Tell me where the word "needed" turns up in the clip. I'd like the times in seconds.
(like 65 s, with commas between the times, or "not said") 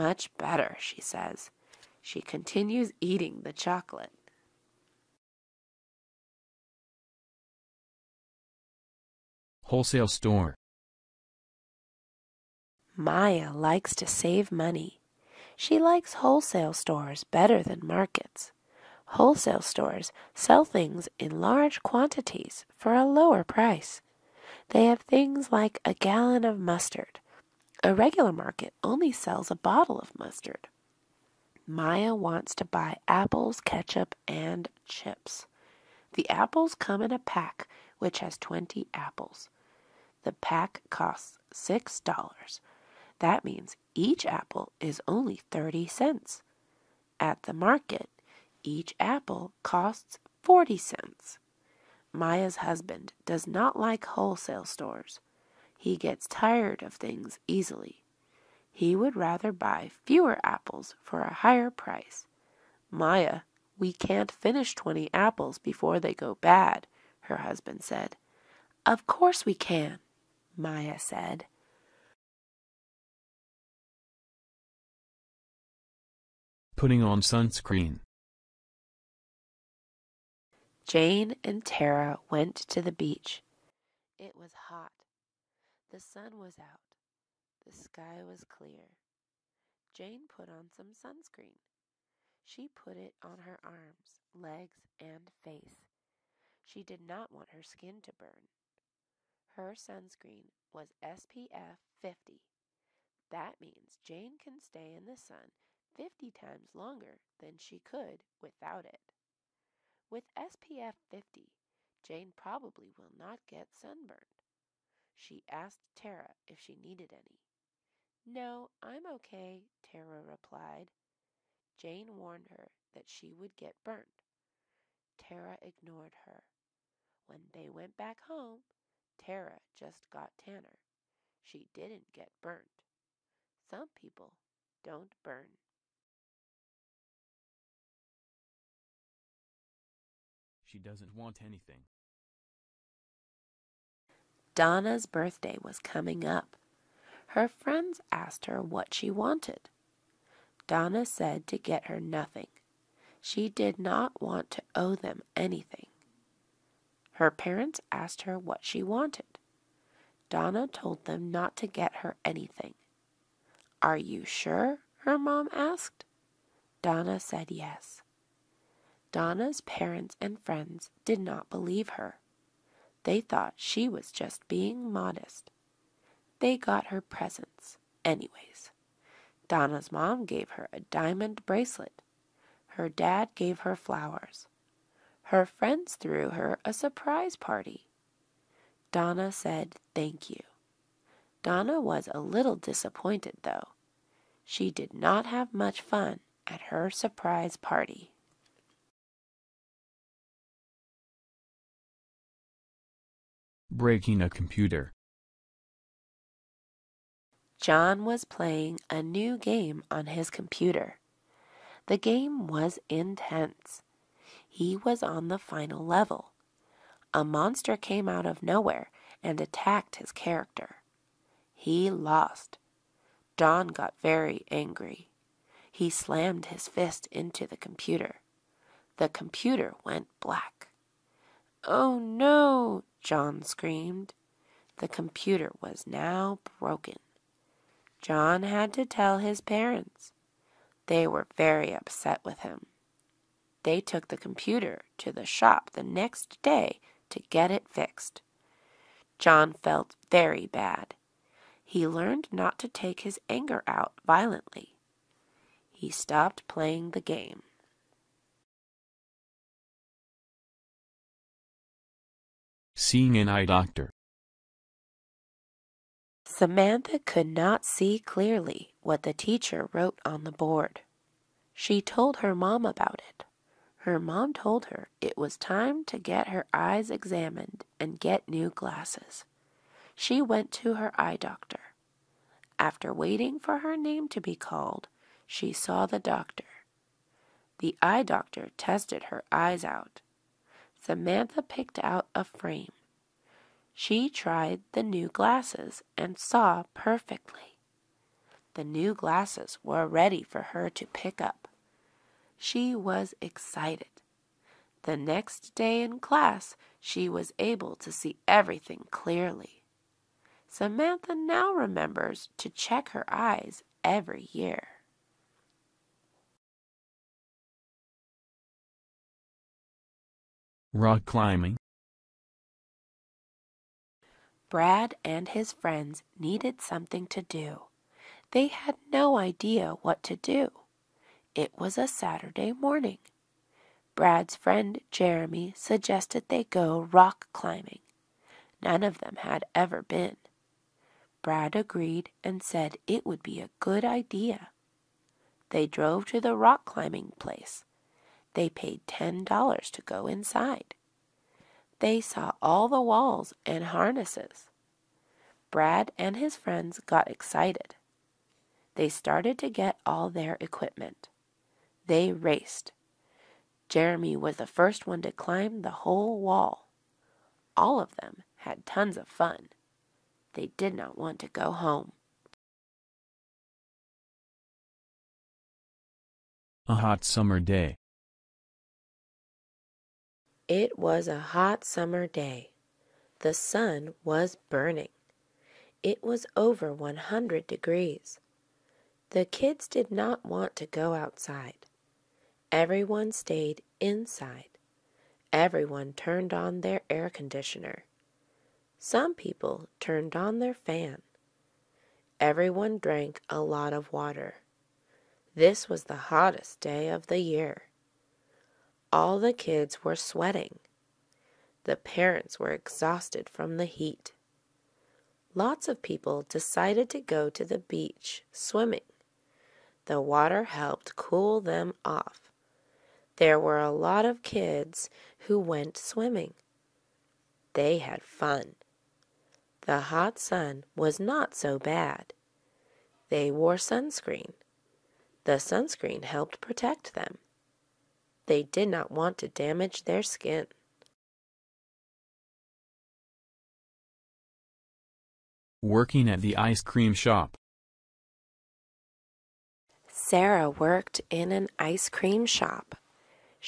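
116 s, 326 s.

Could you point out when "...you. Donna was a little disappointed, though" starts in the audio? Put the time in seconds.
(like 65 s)
190 s.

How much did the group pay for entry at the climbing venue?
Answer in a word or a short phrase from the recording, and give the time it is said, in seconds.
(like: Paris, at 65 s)
$10, at 348 s.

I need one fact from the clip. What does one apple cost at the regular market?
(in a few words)
40 cents.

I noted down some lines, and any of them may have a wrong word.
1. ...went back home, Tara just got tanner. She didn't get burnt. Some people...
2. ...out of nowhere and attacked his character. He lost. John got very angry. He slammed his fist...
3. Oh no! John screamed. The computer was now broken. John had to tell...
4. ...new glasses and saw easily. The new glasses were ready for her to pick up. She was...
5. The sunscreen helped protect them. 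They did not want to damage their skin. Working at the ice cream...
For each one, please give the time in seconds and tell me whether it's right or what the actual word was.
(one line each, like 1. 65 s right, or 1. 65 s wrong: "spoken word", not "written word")
1. 127 s right
2. 218 s right
3. 231 s right
4. 294 s wrong: "perfectly", not "easily"
5. 435 s right.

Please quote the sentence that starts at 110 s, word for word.
With SPF 50, Jane probably will not get sunburned.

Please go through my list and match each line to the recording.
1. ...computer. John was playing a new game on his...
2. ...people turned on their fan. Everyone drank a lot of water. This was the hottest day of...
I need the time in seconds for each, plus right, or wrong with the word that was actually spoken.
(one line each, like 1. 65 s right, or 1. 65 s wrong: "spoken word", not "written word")
1. 204 s right
2. 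399 s right.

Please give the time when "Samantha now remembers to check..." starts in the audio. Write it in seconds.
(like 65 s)
310 s.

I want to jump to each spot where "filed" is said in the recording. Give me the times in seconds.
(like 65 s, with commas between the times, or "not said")
not said.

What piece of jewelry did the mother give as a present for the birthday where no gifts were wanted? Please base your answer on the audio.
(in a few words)
diamond bracelet.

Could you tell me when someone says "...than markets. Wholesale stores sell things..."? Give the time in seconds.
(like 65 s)
17 s.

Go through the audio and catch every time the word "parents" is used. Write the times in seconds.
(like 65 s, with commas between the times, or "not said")
157 s, 169 s, 239 s, 411 s.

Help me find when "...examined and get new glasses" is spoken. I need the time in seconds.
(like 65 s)
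276 s.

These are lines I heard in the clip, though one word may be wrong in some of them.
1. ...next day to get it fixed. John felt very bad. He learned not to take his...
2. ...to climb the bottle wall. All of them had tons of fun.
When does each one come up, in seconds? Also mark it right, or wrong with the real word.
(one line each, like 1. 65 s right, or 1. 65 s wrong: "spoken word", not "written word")
1. 245 s right
2. 365 s wrong: "whole", not "bottle".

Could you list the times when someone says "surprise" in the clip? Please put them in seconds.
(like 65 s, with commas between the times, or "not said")
186 s, 196 s.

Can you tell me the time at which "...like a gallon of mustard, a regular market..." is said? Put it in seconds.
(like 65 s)
25 s.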